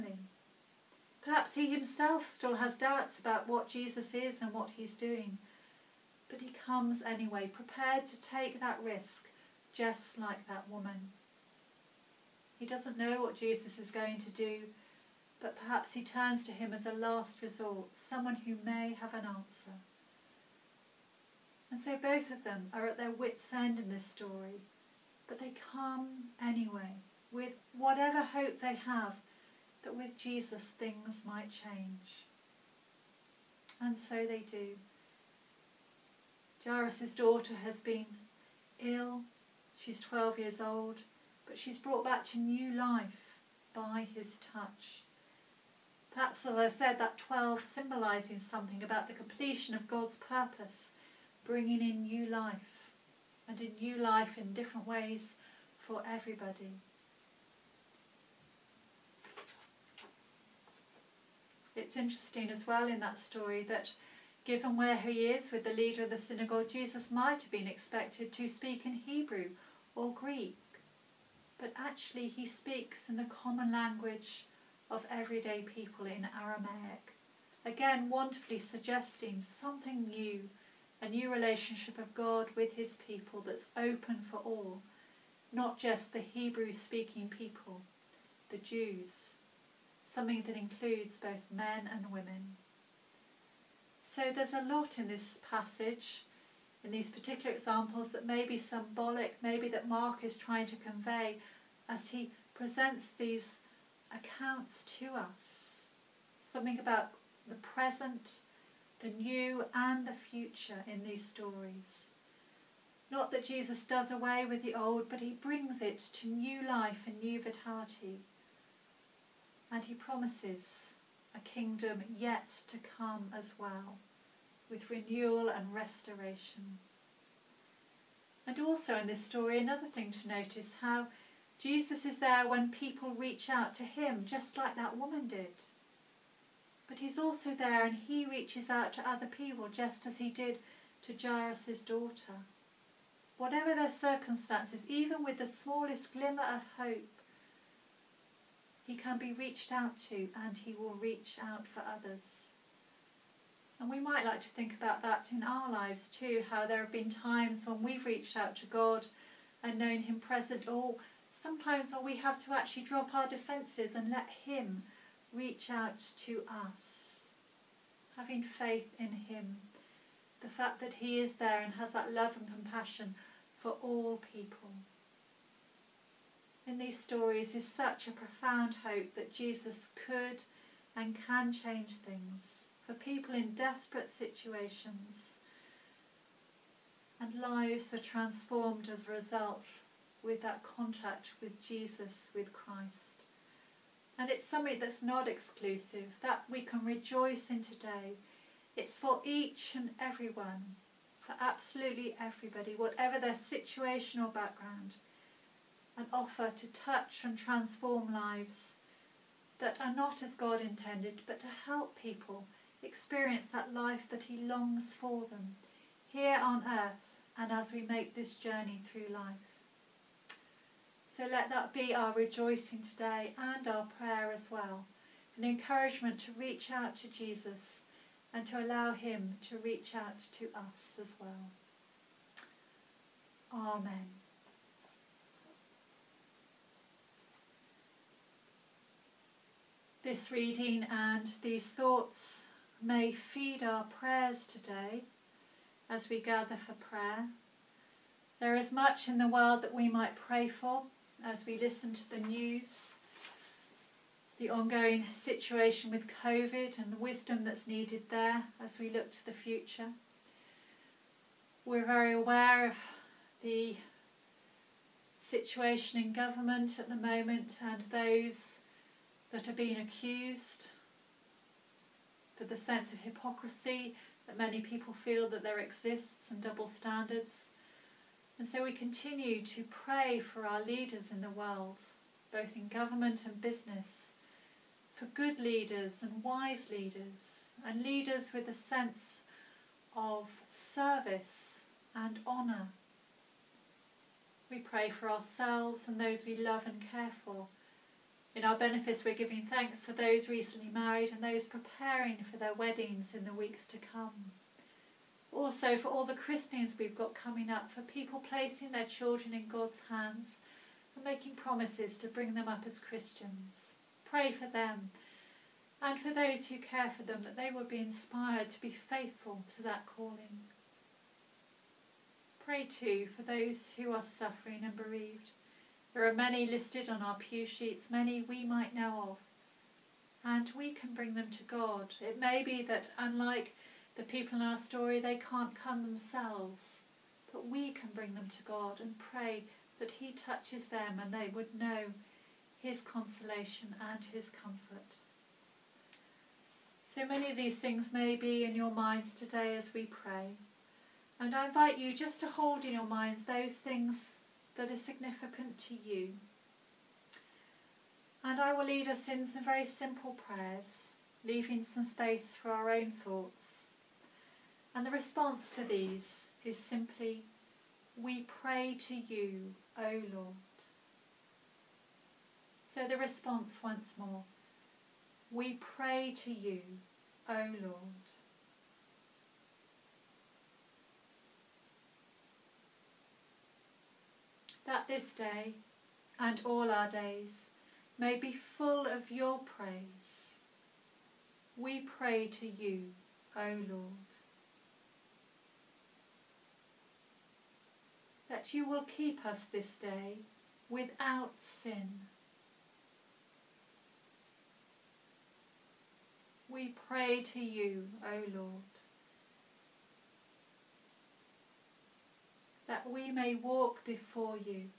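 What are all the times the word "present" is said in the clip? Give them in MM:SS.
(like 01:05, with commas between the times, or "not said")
01:42, 01:47, 02:40.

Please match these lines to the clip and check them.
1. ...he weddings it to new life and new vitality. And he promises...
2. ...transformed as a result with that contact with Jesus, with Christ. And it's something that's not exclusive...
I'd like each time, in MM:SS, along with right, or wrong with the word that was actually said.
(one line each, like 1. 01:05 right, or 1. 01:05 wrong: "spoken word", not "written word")
1. 01:55 wrong: "brings", not "weddings"
2. 03:07 right.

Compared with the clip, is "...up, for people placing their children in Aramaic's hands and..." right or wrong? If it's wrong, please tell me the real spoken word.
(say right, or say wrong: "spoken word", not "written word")
wrong: "God", not "Aramaic".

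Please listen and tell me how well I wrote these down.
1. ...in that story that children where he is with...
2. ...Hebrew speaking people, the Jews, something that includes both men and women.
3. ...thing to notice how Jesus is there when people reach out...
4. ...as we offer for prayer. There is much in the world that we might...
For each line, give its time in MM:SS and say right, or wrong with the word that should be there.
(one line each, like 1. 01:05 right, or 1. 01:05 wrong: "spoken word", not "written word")
1. 01:02 wrong: "given", not "children"
2. 01:26 right
3. 02:09 right
4. 04:05 wrong: "gather", not "offer".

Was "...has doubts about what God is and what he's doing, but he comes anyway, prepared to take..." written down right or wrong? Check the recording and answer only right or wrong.
wrong.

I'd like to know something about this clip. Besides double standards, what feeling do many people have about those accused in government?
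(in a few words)
Hypocrisy.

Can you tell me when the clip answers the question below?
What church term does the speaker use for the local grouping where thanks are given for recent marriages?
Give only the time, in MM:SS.
04:58.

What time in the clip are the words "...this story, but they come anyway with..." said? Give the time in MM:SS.
00:23.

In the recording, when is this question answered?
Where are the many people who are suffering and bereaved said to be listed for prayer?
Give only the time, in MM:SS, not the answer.
05:27.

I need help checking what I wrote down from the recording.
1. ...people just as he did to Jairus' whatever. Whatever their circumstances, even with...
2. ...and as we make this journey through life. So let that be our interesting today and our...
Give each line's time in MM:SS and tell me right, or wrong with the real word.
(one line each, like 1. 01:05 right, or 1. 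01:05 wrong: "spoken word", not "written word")
1. 02:19 wrong: "daughter", not "whatever"
2. 03:37 wrong: "rejoicing", not "interesting".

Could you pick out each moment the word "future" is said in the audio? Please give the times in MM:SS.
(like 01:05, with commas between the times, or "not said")
01:50, 04:19.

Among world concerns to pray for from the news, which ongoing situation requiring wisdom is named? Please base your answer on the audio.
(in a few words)
COVID.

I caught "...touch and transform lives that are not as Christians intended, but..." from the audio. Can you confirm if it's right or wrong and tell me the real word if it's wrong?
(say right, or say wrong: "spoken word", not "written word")
wrong: "God", not "Christians".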